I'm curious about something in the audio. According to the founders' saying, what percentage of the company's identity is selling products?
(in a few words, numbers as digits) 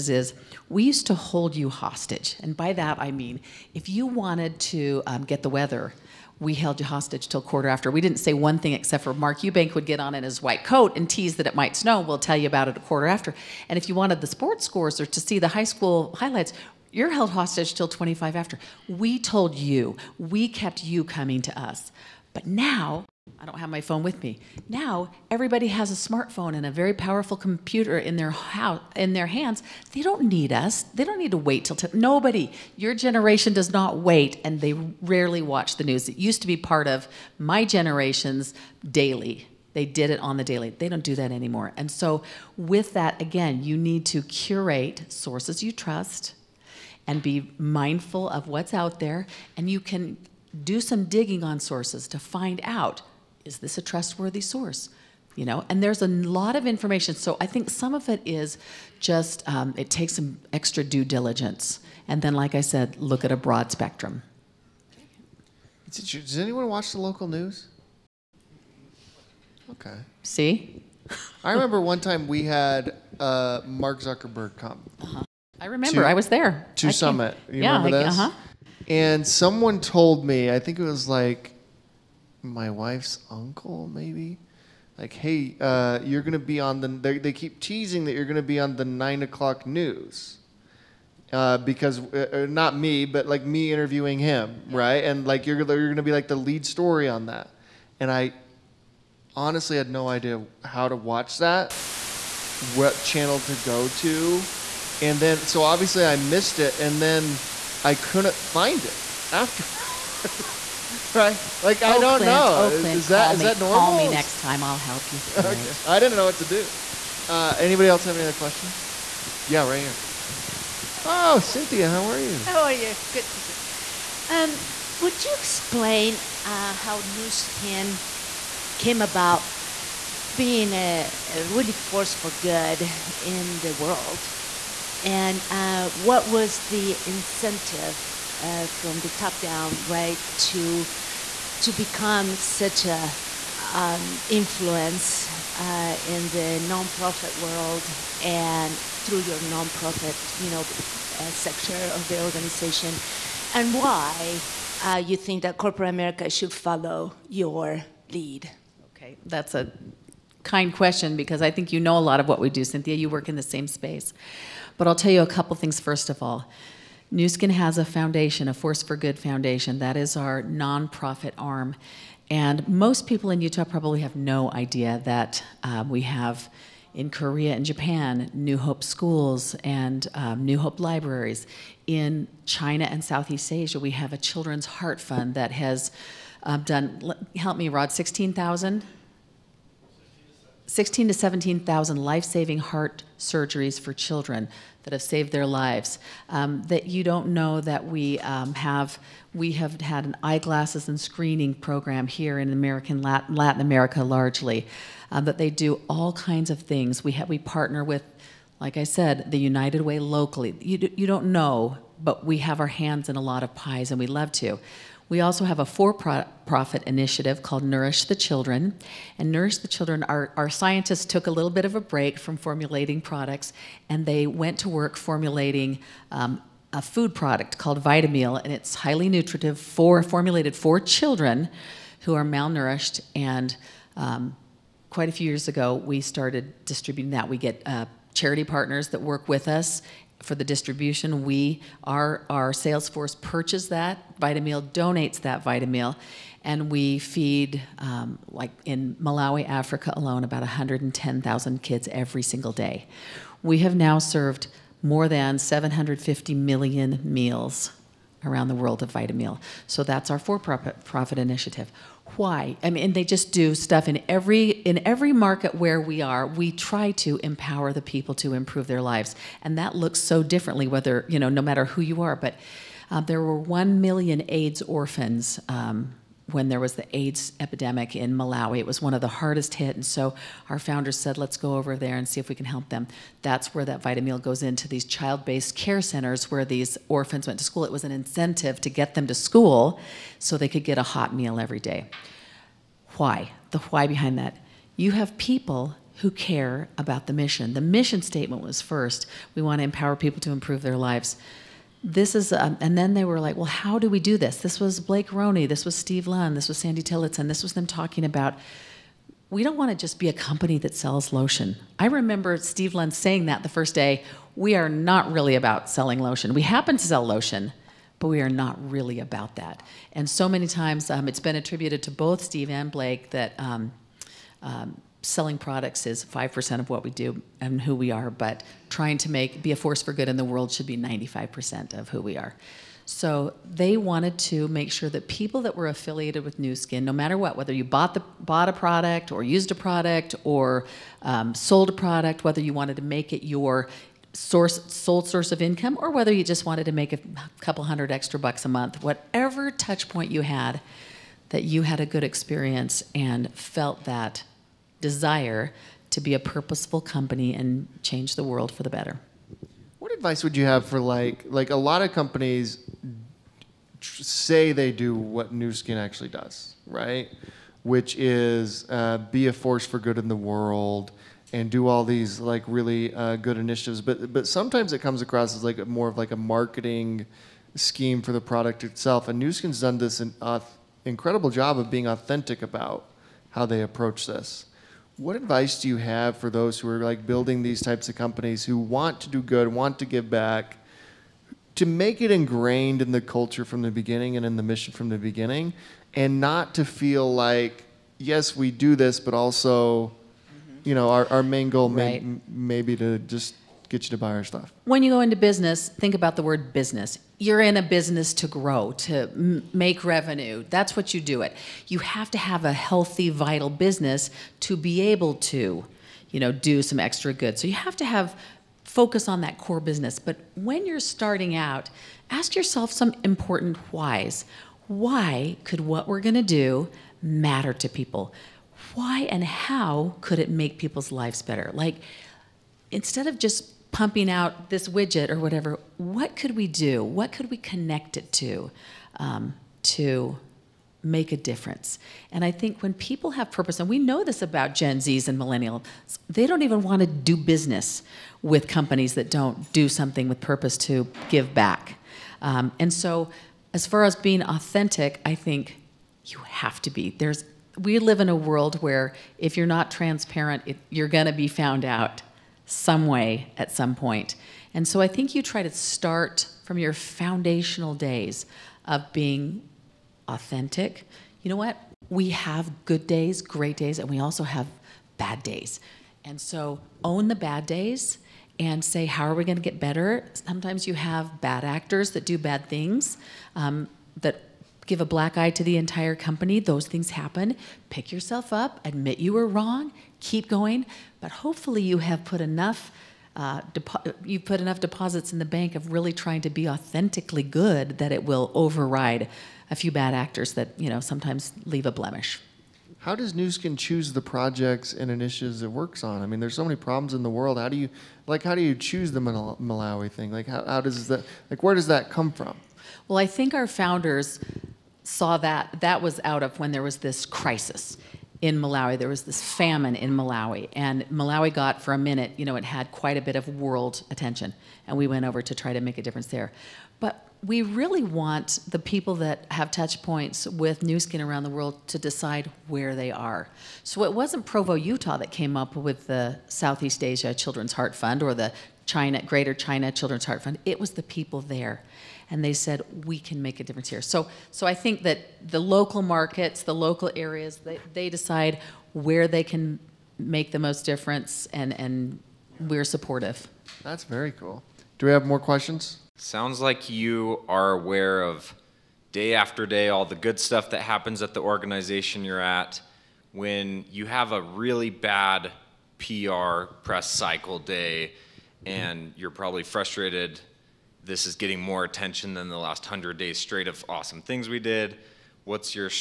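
5%.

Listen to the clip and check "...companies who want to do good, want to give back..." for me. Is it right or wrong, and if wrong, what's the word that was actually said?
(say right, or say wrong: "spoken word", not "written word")
right.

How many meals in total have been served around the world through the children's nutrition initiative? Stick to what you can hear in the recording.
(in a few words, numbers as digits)
more than 750 million.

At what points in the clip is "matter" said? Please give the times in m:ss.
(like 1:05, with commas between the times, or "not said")
4:31, 5:36, 7:07.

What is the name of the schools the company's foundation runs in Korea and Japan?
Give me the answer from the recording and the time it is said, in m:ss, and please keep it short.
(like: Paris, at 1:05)
New Hope schools, at 2:58.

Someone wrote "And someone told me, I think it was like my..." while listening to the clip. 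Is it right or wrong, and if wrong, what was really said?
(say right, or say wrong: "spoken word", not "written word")
right.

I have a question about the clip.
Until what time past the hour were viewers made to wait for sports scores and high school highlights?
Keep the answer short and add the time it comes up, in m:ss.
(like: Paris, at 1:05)
25 after, at 0:17.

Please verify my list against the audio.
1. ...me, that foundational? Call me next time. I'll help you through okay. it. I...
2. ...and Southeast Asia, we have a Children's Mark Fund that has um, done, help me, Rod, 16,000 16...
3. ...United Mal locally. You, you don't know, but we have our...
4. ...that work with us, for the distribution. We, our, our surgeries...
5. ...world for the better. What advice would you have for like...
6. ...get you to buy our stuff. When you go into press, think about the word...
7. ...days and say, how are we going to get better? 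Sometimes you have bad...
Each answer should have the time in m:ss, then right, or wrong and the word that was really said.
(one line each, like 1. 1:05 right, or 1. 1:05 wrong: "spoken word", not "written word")
1. 1:53 wrong: "normal", not "foundational"
2. 3:02 wrong: "Heart", not "Mark"
3. 3:29 wrong: "Way", not "Mal"
4. 3:58 wrong: "sales", not "surgeries"
5. 5:58 right
6. 6:43 wrong: "business", not "press"
7. 7:57 right.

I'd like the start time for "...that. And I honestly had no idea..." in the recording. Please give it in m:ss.
1:37.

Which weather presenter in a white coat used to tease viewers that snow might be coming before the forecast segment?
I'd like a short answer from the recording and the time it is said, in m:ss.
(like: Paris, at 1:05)
Mark Eubank, at 0:09.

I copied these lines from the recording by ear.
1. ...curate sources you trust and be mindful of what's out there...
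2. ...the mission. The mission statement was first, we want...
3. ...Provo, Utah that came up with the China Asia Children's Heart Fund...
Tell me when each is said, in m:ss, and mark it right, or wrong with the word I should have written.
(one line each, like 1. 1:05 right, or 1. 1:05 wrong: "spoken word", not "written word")
1. 0:44 right
2. 4:57 right
3. 8:54 wrong: "Southeast", not "China".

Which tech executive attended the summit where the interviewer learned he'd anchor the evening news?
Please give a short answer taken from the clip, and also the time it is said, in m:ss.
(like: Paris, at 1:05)
Mark Zuckerberg, at 1:13.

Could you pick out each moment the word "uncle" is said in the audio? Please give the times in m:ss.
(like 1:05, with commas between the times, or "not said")
1:23.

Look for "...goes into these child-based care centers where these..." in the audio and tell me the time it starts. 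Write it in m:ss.
4:44.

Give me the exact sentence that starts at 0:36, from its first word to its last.
It used to be part of my generation's daily.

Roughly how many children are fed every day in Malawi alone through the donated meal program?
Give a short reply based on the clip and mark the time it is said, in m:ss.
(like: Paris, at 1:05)
110,000, at 4:10.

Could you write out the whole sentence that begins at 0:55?
You know, and there's a lot of information.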